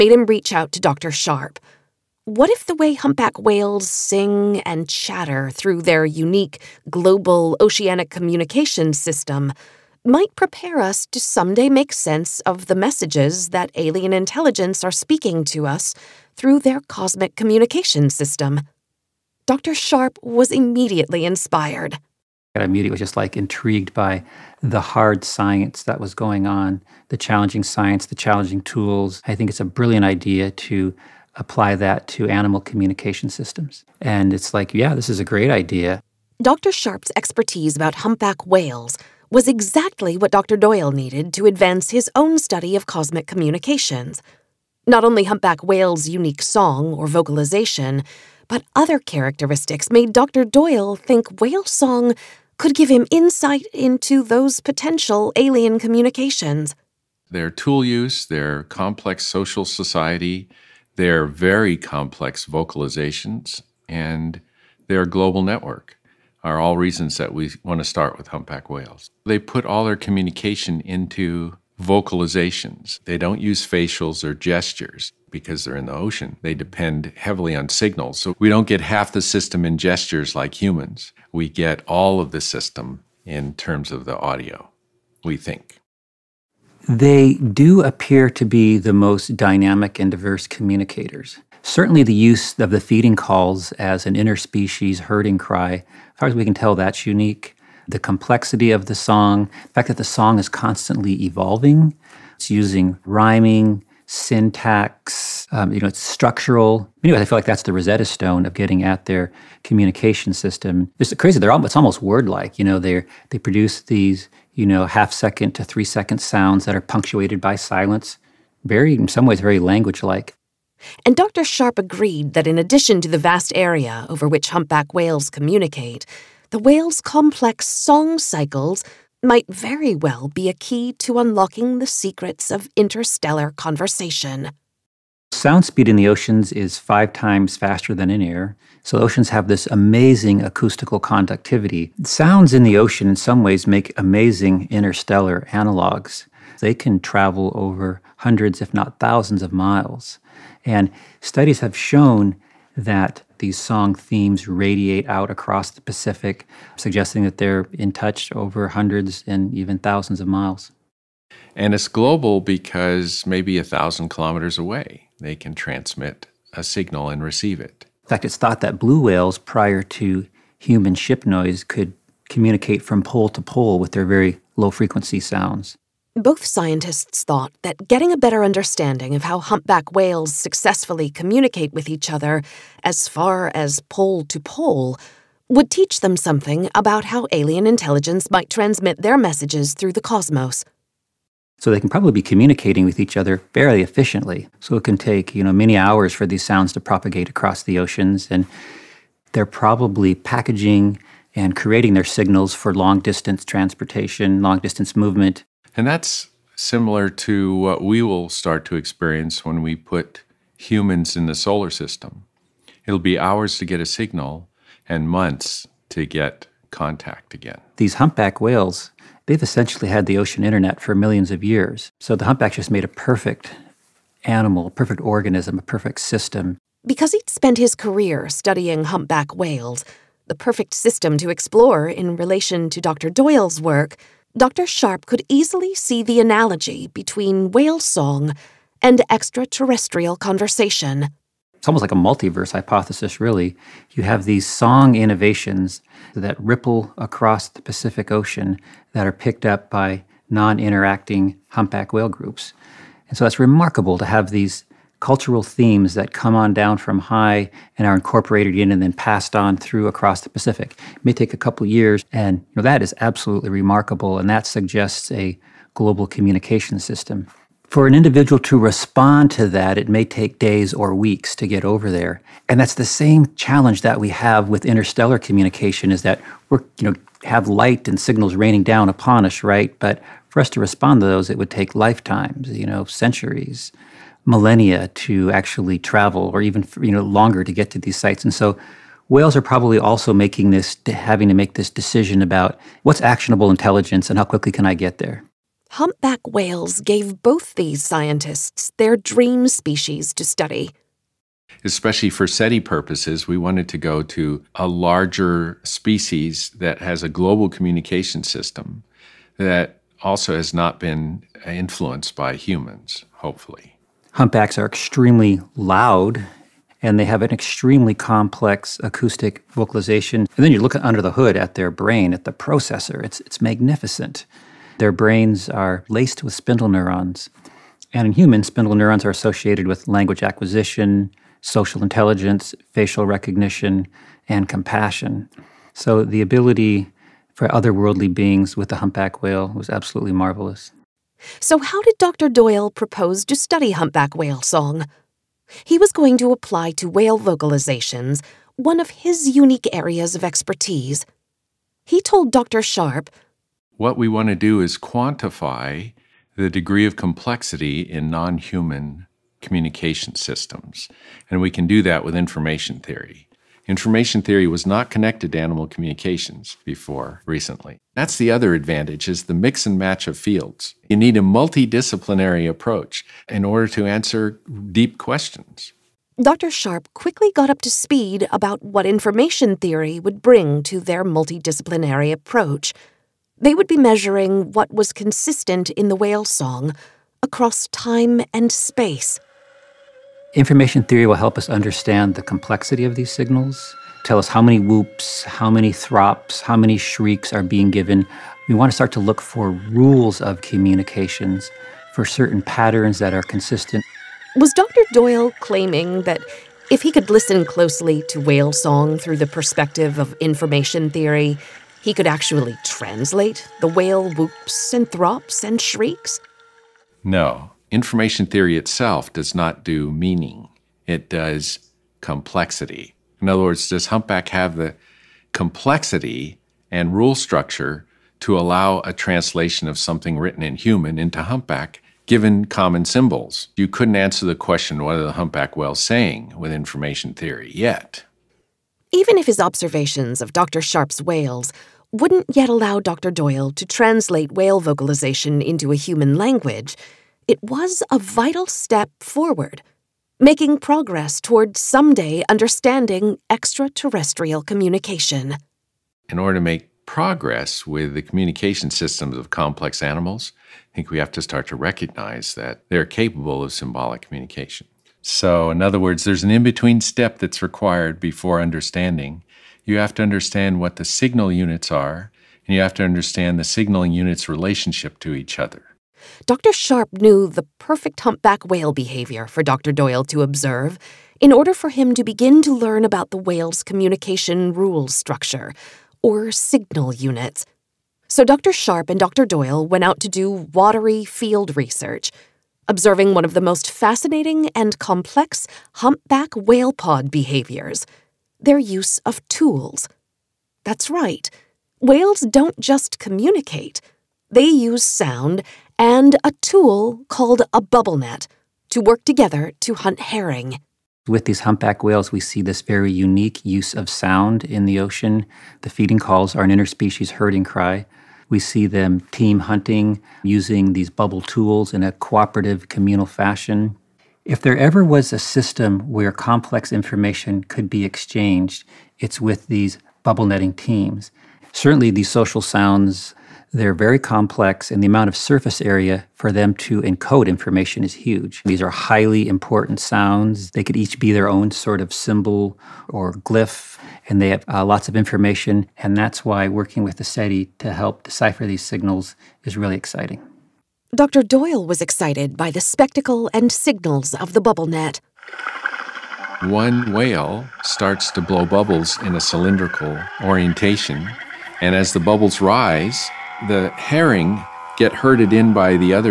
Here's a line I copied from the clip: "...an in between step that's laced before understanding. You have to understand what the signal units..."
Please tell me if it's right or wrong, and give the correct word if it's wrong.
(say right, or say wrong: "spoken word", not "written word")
wrong: "required", not "laced".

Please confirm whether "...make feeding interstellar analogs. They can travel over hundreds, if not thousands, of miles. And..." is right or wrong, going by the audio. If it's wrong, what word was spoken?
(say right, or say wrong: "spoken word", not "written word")
wrong: "amazing", not "feeding".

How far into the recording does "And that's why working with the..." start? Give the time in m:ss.
9:05.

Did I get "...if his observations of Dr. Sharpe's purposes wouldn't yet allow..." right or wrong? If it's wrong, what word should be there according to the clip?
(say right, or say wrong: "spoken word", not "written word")
wrong: "whales", not "purposes".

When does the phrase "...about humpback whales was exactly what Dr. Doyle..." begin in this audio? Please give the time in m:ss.
0:37.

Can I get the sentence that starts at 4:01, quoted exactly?
It's almost like a multiverse hypothesis, really.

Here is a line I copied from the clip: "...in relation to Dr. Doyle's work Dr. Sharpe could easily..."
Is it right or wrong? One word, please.
right.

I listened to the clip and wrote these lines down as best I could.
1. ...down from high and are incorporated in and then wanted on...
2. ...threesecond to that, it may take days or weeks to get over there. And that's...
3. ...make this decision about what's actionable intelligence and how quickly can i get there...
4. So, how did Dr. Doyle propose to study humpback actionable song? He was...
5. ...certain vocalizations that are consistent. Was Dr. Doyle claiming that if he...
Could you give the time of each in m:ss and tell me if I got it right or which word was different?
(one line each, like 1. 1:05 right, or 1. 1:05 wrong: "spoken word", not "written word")
1. 4:16 wrong: "passed", not "wanted"
2. 4:28 wrong: "respond", not "threesecond"
3. 4:51 right
4. 5:41 wrong: "whale", not "actionable"
5. 6:42 wrong: "patterns", not "vocalizations".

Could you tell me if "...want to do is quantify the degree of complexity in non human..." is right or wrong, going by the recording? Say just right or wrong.
right.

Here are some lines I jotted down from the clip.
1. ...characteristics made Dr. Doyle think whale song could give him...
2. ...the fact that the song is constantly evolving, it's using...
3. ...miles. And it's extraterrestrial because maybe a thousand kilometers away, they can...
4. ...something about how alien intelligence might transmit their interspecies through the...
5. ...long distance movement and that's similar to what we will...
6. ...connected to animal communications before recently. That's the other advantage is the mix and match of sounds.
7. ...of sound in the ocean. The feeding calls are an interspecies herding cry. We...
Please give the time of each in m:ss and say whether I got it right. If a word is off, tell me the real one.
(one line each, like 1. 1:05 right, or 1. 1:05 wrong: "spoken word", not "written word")
1. 0:48 right
2. 1:39 right
3. 2:40 wrong: "global", not "extraterrestrial"
4. 3:06 wrong: "messages", not "interspecies"
5. 3:24 right
6. 6:04 wrong: "fields", not "sounds"
7. 8:33 right.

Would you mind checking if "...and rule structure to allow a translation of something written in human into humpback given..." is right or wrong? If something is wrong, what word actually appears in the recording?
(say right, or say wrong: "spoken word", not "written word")
right.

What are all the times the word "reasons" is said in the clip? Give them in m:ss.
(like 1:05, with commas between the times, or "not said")
1:06.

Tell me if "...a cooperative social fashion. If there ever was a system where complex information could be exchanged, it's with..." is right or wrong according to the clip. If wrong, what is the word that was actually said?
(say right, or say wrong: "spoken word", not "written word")
wrong: "communal", not "social".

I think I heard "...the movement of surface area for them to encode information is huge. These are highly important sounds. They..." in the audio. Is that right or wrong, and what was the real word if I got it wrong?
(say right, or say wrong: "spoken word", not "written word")
wrong: "amount", not "movement".